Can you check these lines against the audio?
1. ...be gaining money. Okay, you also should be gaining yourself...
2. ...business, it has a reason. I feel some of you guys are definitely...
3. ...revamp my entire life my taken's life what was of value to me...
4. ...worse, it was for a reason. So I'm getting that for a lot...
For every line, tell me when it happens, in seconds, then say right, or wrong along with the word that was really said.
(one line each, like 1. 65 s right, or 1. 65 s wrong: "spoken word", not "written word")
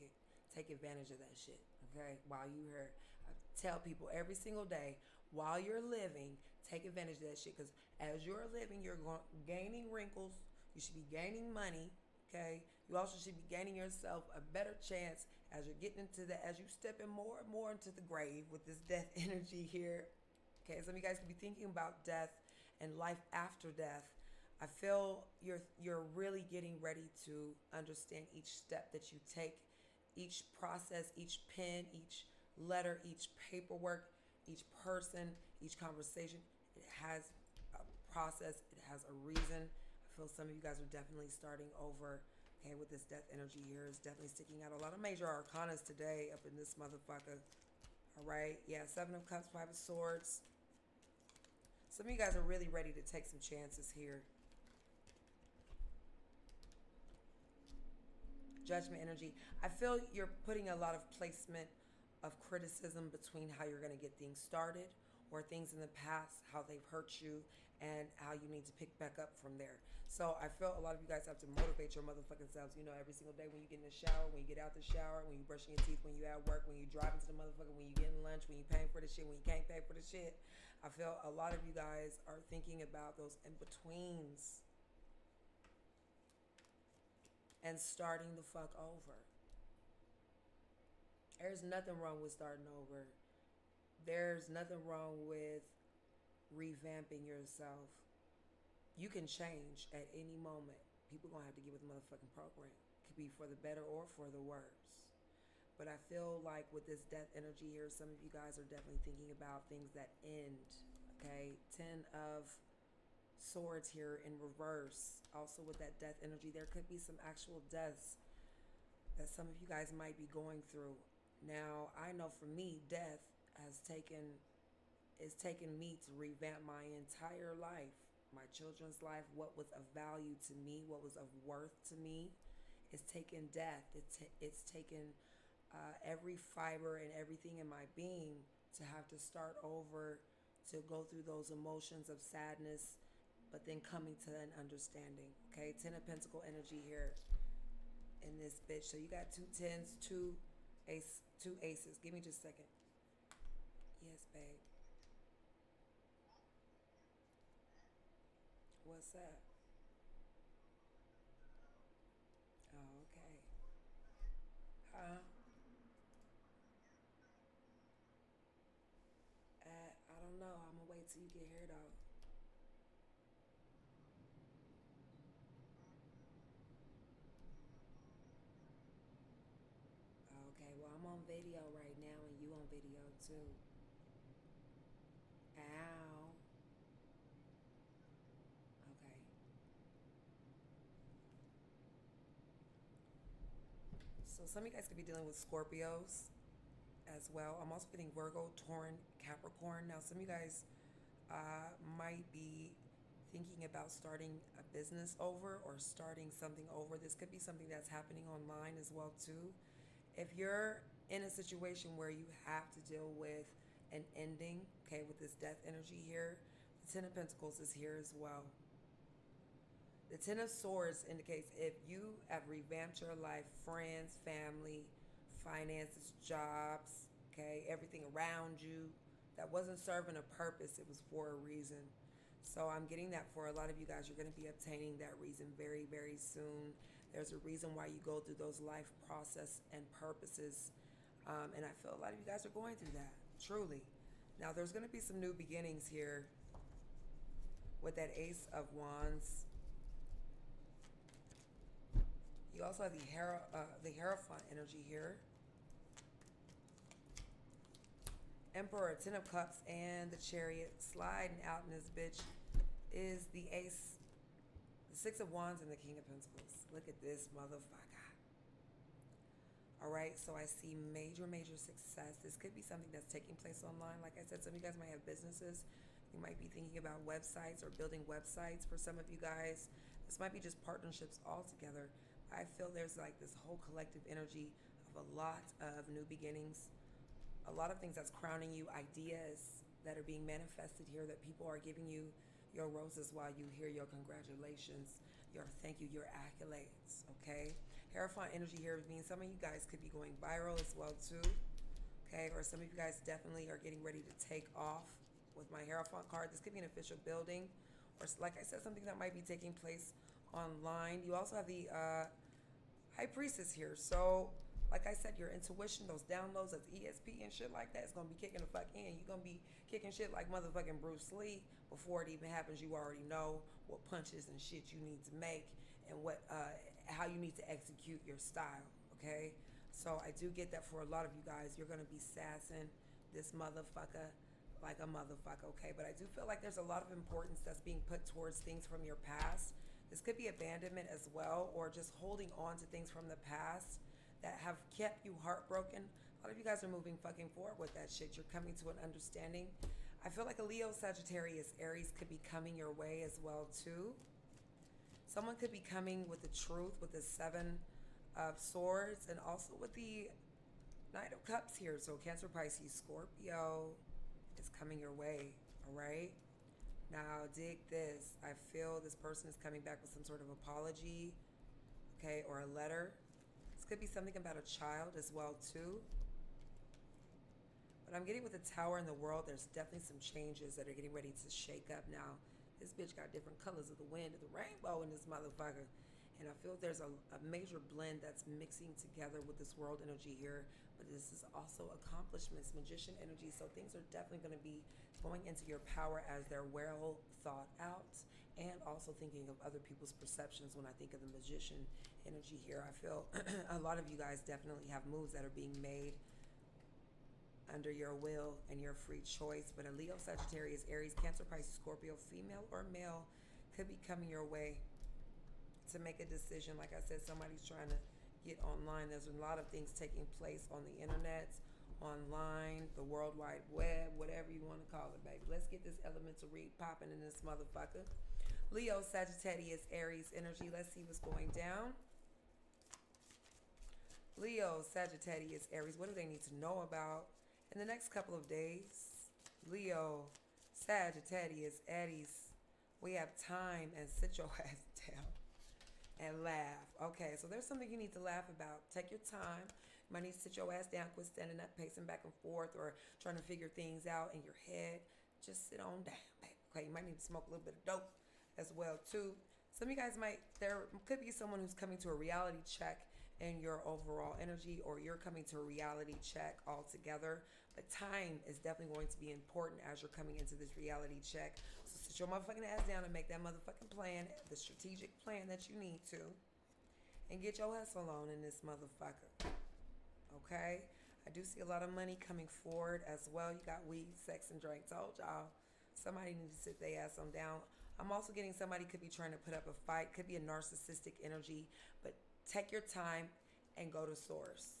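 1. 10 s right
2. 38 s wrong: "process", not "business"
3. 126 s wrong: "children", not "taken"
4. 230 s wrong: "purpose", not "worse".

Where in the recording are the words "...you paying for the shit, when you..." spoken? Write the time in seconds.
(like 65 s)
78 s.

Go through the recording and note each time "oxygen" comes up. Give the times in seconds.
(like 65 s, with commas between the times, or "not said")
not said.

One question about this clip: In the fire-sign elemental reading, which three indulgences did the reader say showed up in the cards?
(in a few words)
weed, sex, and drink.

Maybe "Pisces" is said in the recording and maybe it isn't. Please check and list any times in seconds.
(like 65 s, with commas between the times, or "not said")
362 s, 411 s.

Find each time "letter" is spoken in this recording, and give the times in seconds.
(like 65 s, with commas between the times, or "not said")
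32 s, 372 s.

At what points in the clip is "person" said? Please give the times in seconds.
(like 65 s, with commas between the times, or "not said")
34 s, 368 s.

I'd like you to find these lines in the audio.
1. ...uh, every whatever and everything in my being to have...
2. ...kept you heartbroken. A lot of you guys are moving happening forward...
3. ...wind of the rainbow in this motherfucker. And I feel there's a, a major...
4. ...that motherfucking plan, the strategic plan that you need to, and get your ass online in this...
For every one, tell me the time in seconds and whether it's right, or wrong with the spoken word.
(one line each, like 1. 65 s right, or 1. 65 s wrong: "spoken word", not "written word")
1. 135 s wrong: "fiber", not "whatever"
2. 344 s wrong: "fucking", not "happening"
3. 383 s right
4. 473 s wrong: "alone", not "online".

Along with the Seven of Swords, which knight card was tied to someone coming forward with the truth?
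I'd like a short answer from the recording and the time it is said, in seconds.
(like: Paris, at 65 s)
Knight of Cups, at 360 s.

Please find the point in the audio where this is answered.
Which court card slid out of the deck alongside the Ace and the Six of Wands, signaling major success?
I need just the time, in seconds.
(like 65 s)
265 s.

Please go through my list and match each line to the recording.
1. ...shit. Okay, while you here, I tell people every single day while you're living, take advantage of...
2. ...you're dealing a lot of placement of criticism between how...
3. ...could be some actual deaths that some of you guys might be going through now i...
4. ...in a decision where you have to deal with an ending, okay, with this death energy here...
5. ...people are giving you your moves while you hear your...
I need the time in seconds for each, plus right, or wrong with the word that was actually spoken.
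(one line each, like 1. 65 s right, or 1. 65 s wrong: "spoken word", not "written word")
1. 1 s right
2. 60 s wrong: "putting", not "dealing"
3. 116 s right
4. 211 s wrong: "situation", not "decision"
5. 291 s wrong: "roses", not "moves".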